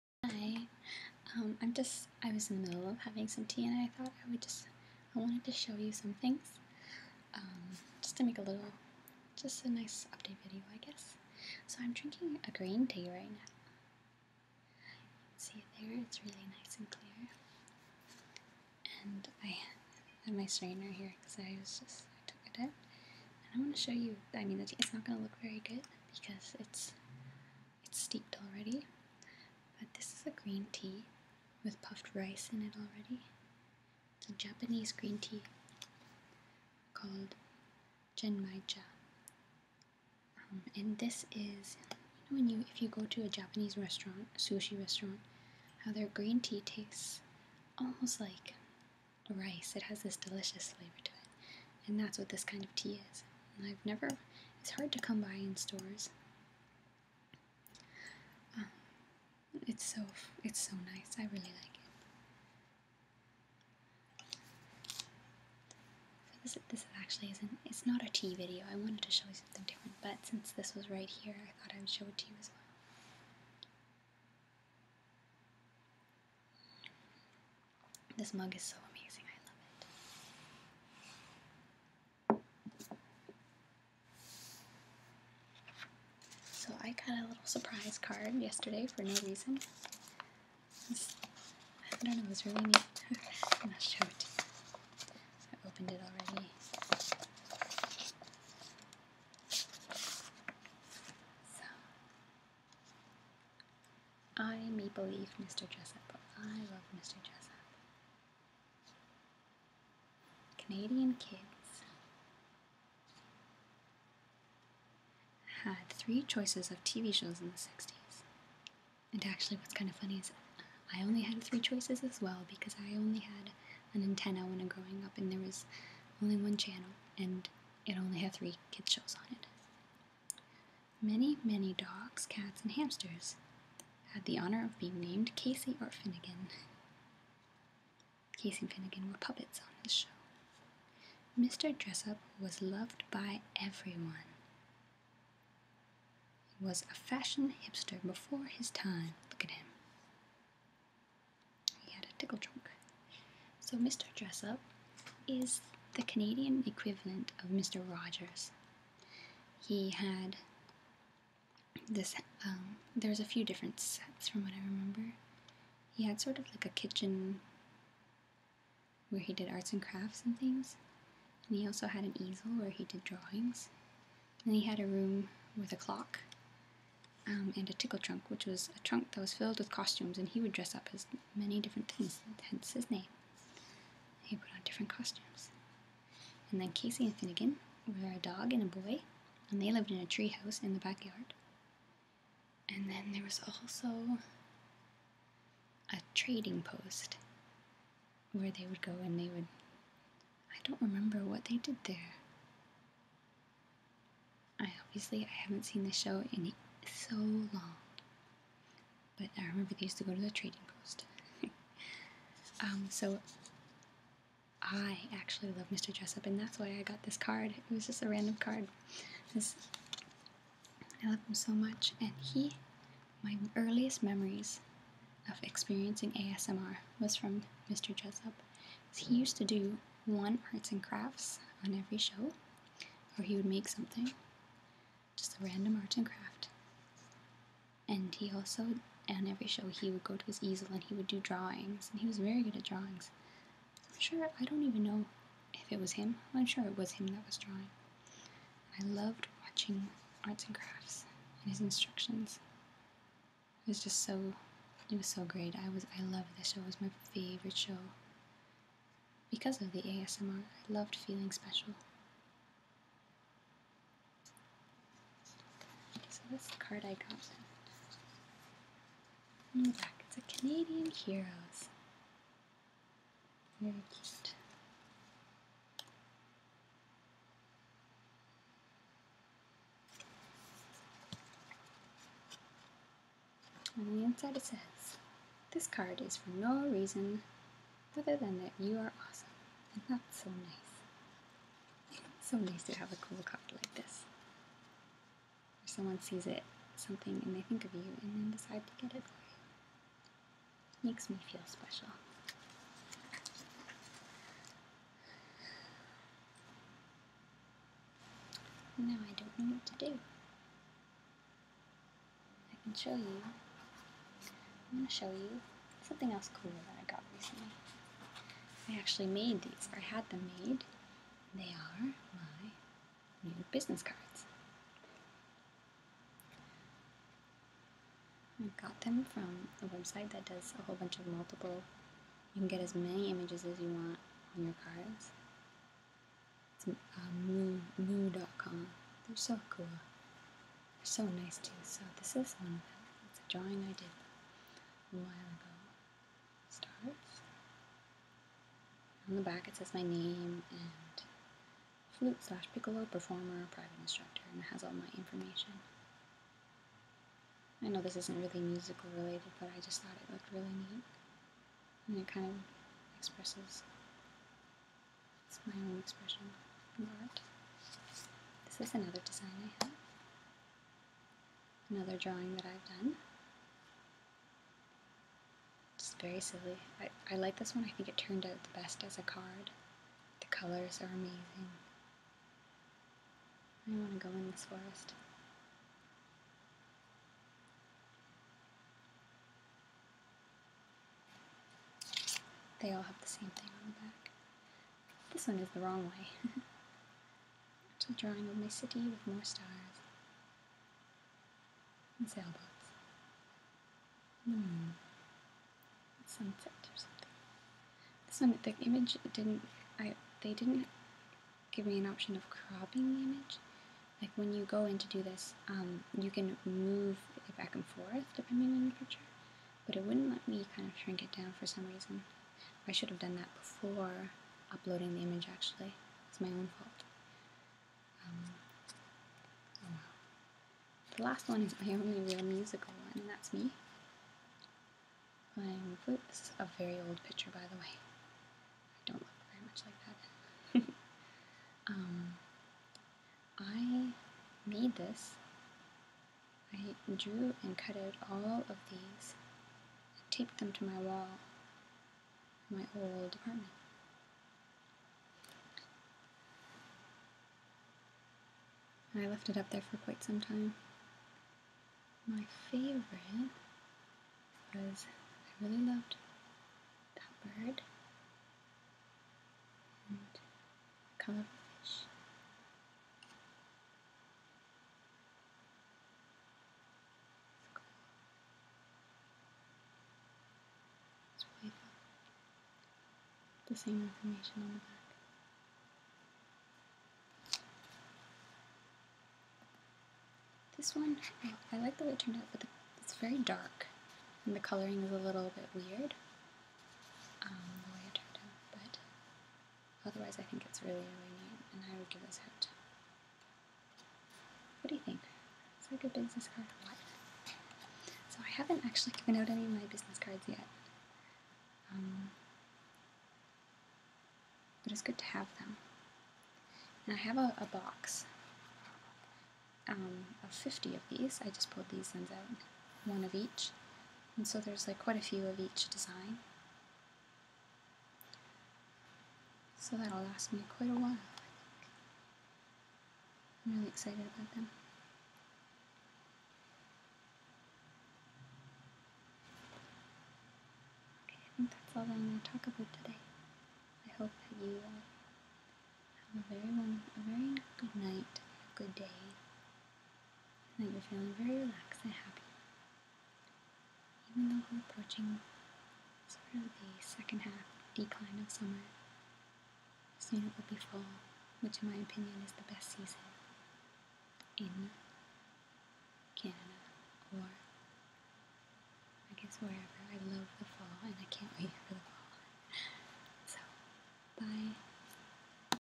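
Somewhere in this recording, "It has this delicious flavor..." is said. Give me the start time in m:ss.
0:49.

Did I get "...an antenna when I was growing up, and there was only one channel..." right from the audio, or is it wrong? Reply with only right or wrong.
right.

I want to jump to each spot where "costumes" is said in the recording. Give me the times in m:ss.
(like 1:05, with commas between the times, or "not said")
2:59, 3:04.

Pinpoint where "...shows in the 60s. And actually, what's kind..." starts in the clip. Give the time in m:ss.
1:57.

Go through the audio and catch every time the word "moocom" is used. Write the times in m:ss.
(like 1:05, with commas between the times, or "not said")
5:37.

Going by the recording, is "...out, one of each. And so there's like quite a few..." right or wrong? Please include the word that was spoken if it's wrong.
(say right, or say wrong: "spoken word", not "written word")
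right.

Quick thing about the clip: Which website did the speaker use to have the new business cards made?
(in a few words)
moo.com.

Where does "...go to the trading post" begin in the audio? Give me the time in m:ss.
3:30.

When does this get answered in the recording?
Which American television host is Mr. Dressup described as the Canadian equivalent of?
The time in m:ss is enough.
2:37.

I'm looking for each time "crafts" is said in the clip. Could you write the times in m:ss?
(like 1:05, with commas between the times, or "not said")
2:49, 3:50, 3:56, 4:10.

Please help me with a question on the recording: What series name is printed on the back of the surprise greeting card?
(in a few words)
Canadian Heroes.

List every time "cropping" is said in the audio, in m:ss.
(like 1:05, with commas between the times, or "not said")
6:52.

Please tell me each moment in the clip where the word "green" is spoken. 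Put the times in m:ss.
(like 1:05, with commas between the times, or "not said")
0:12, 0:30, 0:34, 0:46.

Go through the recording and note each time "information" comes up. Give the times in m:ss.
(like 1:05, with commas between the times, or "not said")
5:54, 8:03.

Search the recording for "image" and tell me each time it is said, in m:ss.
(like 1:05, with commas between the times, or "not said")
5:33, 6:48, 6:53, 7:05.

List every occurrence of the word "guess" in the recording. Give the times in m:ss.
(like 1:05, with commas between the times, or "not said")
0:10, 9:29.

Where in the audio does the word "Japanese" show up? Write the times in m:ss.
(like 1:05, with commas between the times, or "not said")
0:34, 0:43.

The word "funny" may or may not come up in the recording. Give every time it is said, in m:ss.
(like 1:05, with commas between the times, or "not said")
1:59.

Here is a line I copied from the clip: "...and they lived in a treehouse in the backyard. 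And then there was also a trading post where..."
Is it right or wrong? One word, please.
right.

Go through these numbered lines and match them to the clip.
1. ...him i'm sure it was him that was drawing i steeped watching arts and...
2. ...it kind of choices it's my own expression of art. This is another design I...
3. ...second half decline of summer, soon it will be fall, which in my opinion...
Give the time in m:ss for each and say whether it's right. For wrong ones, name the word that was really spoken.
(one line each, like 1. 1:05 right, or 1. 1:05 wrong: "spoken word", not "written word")
1. 4:05 wrong: "loved", not "steeped"
2. 6:01 wrong: "expresses", not "choices"
3. 9:16 right.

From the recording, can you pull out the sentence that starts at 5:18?
I actually made these, I had them made.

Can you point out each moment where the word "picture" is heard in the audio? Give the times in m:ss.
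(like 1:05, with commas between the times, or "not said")
6:58, 7:17.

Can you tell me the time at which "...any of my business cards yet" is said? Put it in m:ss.
8:29.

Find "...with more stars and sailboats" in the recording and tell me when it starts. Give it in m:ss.
6:38.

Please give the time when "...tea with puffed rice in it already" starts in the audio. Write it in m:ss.
0:30.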